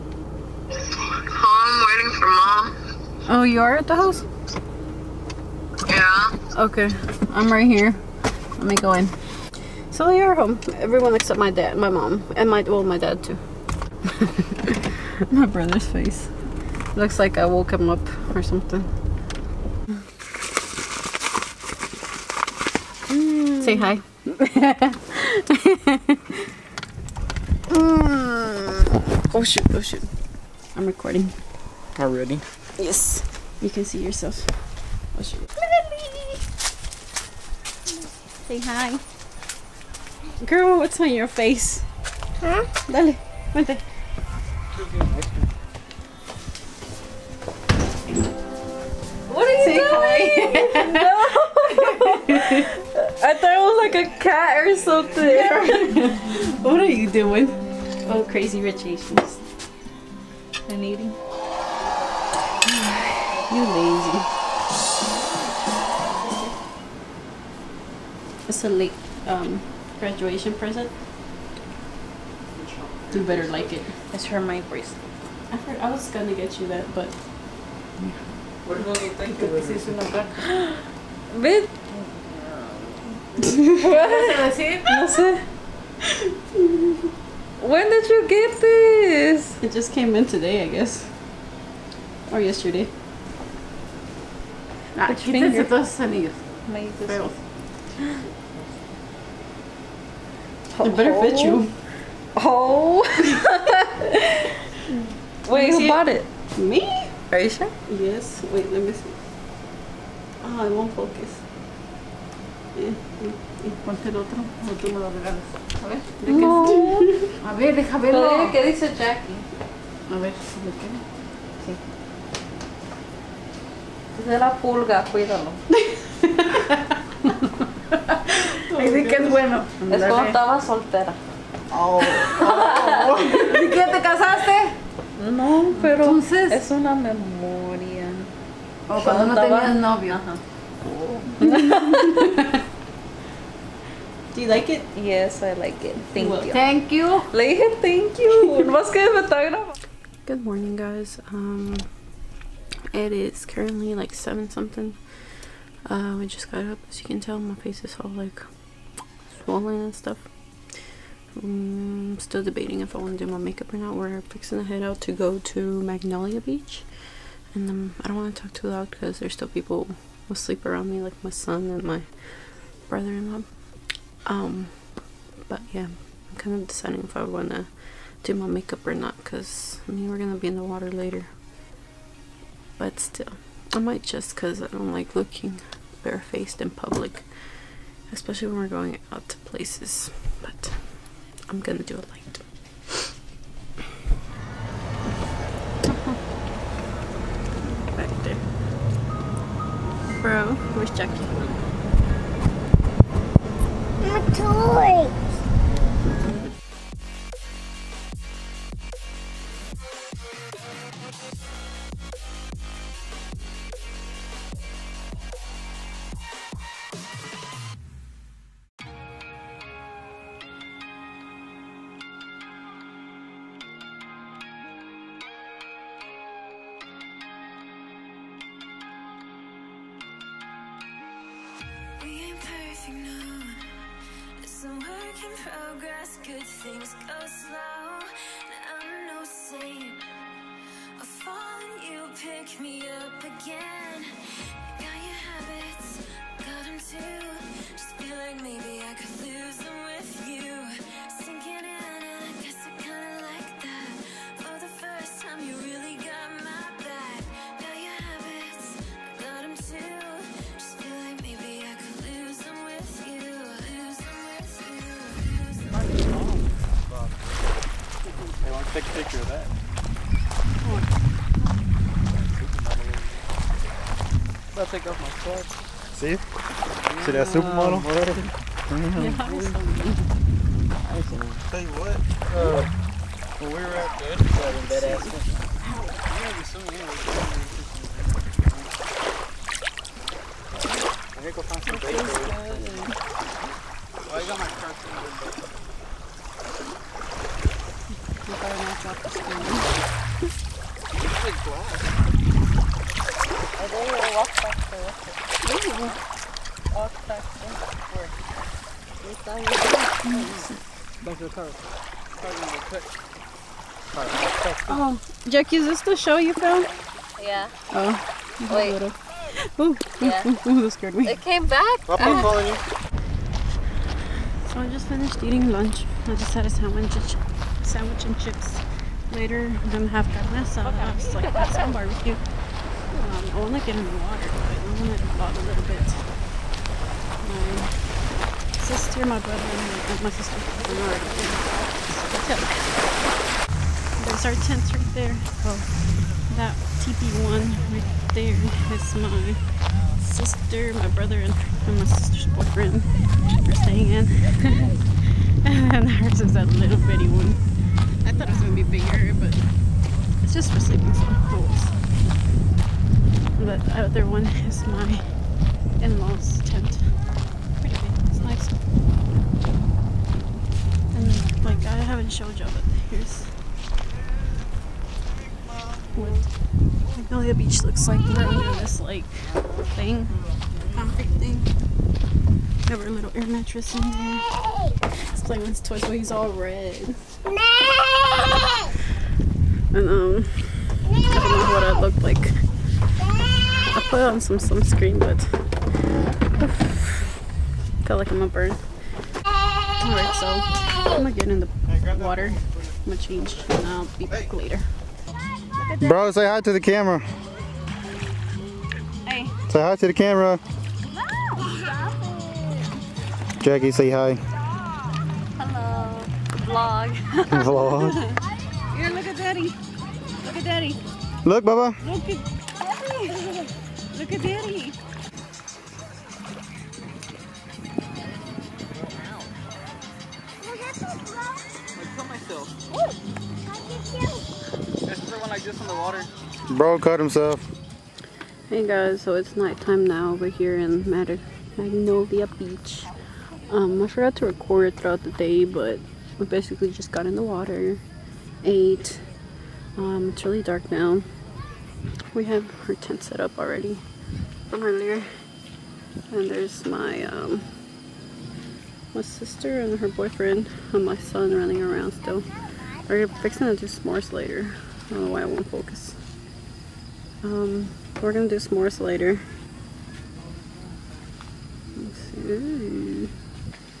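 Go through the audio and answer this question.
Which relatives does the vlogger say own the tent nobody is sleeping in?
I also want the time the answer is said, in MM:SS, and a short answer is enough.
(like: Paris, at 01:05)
in-laws, at 06:05.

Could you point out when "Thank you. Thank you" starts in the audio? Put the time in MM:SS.
02:26.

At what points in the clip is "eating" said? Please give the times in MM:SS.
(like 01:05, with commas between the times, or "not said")
01:00, 05:25.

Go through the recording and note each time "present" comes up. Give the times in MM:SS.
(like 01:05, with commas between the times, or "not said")
01:10.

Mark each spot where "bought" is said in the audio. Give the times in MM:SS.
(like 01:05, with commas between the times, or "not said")
01:45.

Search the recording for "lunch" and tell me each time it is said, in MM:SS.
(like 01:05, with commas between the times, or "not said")
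05:25.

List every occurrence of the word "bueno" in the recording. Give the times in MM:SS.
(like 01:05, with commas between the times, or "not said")
02:09.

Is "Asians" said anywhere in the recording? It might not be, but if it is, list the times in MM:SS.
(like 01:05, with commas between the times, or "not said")
00:58.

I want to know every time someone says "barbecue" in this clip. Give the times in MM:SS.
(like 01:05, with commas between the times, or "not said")
05:31.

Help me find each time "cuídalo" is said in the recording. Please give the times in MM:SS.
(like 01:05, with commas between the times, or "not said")
02:05.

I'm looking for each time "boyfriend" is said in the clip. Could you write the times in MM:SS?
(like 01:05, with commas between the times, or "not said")
05:52, 07:39.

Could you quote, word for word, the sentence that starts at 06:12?
shoujo, but here's what Magnolia Beach looks like.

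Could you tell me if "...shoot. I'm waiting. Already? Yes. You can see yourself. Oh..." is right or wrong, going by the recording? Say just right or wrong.
wrong.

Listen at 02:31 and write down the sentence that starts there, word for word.
Um, it is currently like seven something.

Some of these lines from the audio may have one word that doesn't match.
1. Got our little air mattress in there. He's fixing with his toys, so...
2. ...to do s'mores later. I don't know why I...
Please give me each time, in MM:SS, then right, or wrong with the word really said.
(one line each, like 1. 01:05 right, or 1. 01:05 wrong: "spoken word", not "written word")
1. 06:22 wrong: "playing", not "fixing"
2. 07:43 right.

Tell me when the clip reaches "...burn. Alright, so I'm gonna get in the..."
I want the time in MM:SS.
06:38.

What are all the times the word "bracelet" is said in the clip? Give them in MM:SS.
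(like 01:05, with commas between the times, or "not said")
01:14.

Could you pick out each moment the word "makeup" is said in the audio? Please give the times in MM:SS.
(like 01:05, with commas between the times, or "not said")
02:43, 02:58.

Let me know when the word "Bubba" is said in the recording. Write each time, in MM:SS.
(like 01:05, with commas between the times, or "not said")
07:01.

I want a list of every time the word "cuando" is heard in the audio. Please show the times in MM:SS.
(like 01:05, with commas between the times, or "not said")
02:10, 02:19.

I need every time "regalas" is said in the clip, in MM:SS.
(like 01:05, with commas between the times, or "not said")
01:55.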